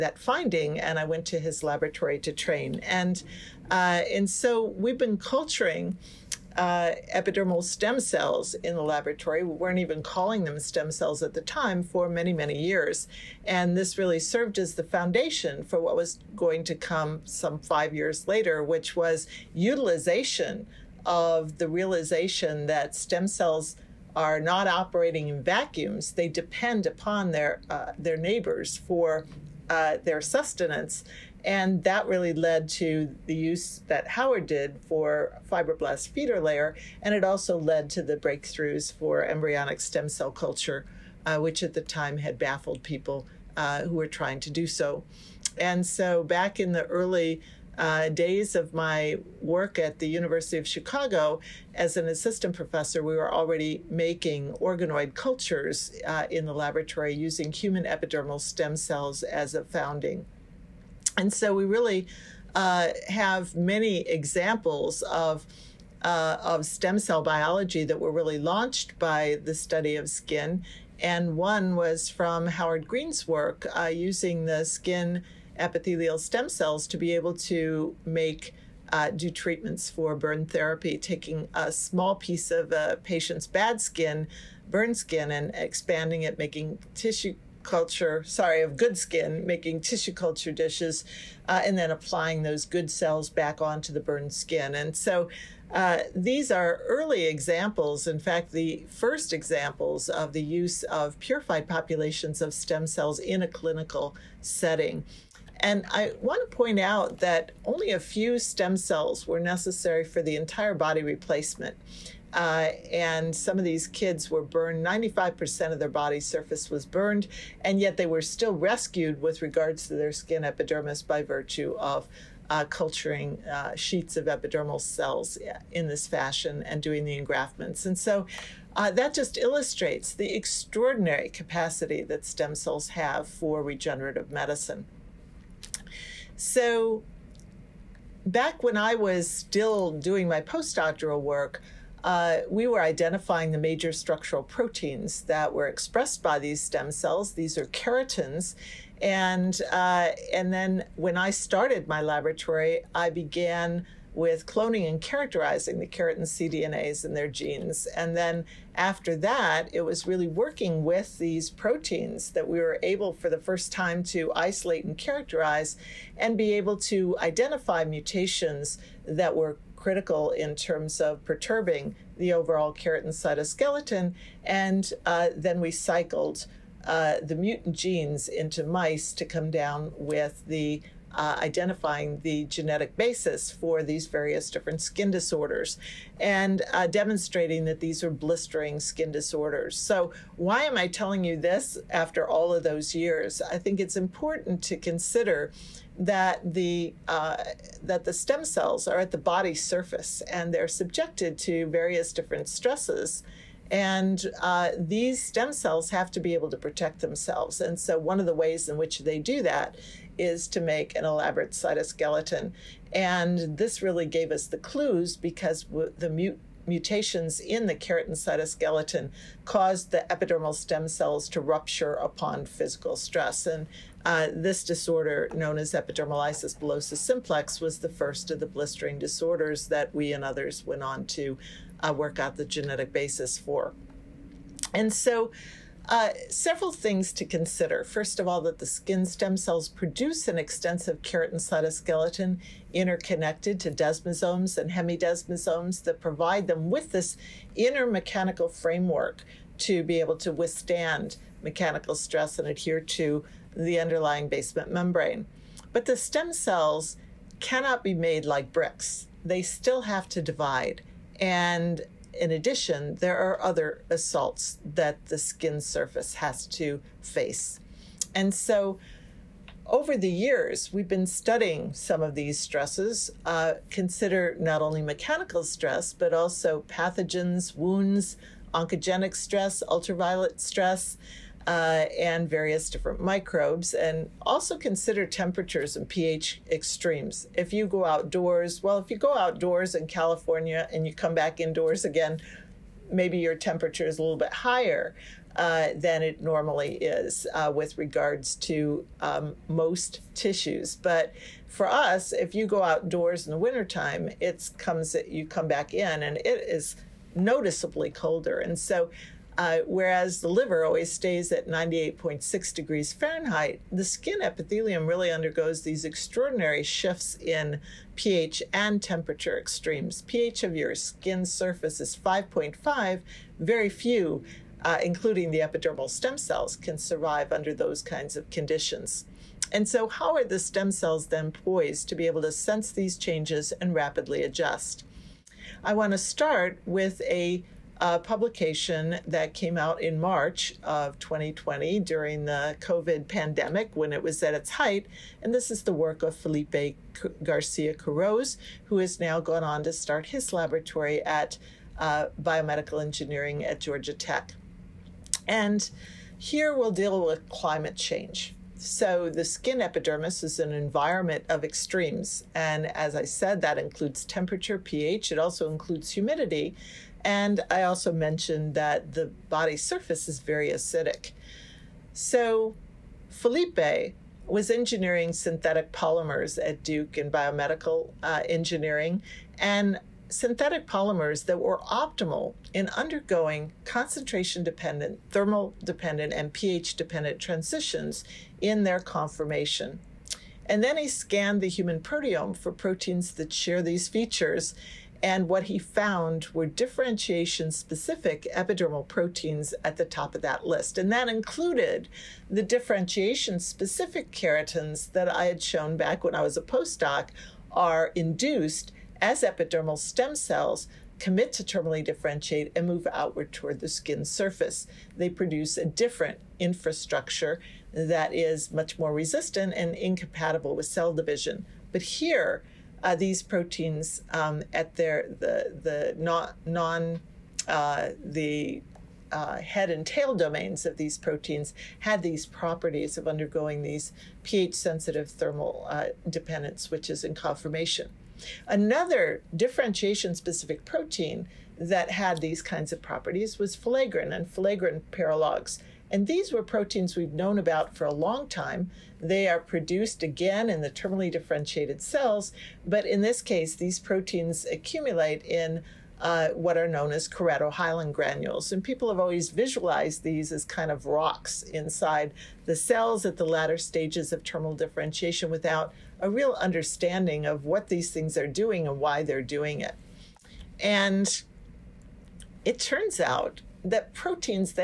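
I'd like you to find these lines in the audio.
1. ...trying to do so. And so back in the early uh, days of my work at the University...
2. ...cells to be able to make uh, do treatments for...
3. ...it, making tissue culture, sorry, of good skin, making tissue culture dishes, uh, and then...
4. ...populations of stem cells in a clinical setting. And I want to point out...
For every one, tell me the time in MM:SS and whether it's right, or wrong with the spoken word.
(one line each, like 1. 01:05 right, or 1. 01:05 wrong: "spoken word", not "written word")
1. 00:44 right
2. 01:16 right
3. 01:26 right
4. 01:41 right.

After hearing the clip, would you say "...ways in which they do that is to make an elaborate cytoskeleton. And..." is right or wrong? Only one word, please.
right.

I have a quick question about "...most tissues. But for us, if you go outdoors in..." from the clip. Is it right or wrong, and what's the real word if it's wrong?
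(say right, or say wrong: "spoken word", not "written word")
right.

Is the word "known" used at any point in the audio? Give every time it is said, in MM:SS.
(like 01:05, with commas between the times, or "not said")
03:45, 07:27, 07:36.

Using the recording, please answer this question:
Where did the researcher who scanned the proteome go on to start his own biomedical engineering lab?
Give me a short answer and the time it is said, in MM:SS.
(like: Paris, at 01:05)
Georgia Tech, at 05:53.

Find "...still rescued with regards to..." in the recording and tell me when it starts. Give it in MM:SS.
01:58.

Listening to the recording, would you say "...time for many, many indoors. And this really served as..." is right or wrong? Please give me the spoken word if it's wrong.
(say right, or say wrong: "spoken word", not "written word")
wrong: "years", not "indoors".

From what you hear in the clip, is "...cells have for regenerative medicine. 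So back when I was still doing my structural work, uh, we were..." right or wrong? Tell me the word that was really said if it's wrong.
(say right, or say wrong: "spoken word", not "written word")
wrong: "postdoctoral", not "structural".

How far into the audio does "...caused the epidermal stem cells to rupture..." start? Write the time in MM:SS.
03:39.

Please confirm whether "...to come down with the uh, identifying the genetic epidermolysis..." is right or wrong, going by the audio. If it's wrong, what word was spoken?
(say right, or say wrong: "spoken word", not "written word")
wrong: "basis", not "epidermolysis".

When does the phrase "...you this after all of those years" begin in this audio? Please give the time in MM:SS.
03:11.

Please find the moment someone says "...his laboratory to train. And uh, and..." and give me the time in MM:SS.
00:01.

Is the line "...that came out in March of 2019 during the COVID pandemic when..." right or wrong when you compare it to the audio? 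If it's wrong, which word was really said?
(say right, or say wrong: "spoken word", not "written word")
wrong: "2020", not "2019".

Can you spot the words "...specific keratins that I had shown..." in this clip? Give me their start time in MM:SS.
06:43.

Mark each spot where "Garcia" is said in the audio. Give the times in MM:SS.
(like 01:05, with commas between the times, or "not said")
05:47.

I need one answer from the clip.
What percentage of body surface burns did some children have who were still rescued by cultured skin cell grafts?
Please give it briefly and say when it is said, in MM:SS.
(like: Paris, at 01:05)
95%, at 01:54.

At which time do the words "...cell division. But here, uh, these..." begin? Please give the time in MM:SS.
07:00.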